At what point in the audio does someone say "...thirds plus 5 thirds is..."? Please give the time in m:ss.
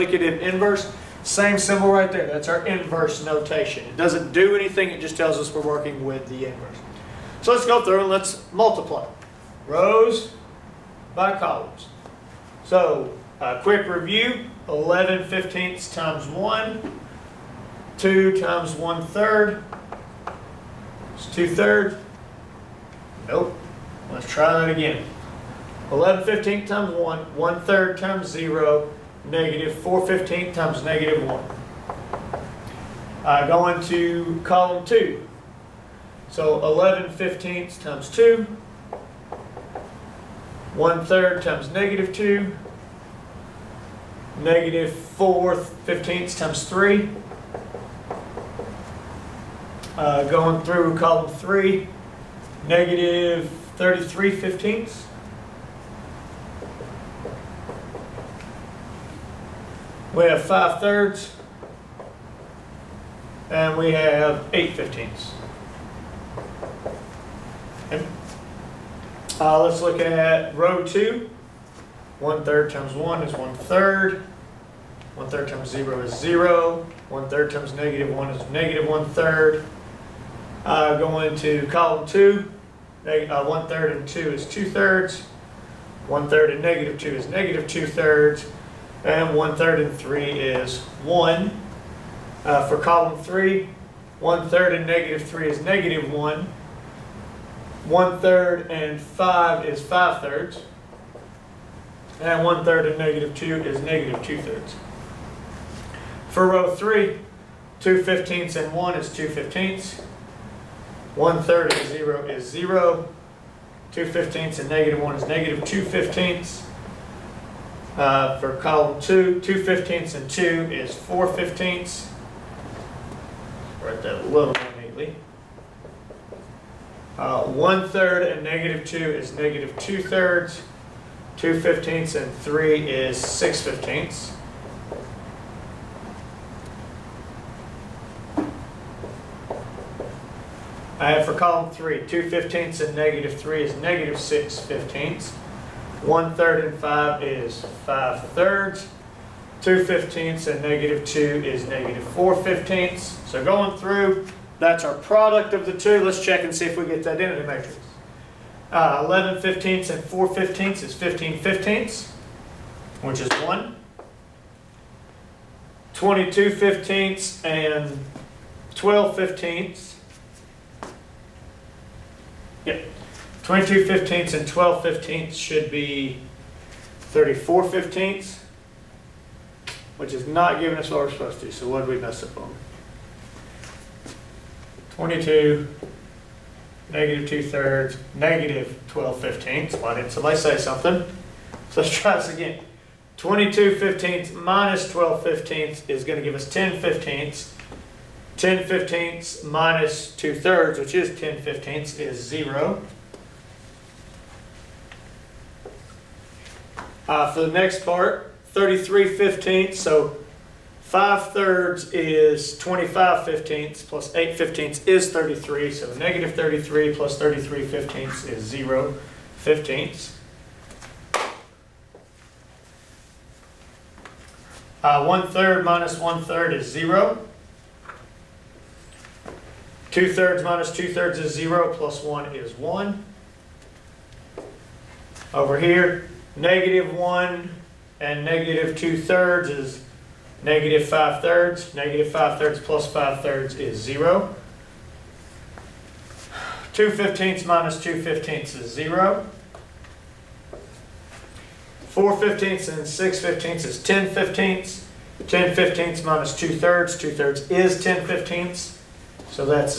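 4:02.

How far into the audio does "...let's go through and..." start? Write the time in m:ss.
0:07.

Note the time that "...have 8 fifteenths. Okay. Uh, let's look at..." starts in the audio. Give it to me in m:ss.
1:03.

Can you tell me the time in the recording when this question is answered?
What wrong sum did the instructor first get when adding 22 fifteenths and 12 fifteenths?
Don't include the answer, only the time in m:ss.
2:56.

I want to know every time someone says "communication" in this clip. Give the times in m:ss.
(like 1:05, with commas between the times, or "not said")
not said.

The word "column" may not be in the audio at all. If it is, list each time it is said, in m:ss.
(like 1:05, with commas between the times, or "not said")
0:11, 0:34, 0:50, 1:21, 1:32, 1:58, 2:21.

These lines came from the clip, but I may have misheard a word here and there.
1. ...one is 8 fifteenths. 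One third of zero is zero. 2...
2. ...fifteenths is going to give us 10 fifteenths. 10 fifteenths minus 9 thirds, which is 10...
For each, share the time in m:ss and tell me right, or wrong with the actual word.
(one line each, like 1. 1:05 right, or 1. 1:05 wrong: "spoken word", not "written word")
1. 1:48 wrong: "2", not "8"
2. 3:15 wrong: "2", not "9".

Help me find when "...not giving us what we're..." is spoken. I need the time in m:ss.
3:00.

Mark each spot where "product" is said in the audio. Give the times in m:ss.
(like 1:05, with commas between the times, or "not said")
2:34.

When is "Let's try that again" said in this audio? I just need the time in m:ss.
0:24.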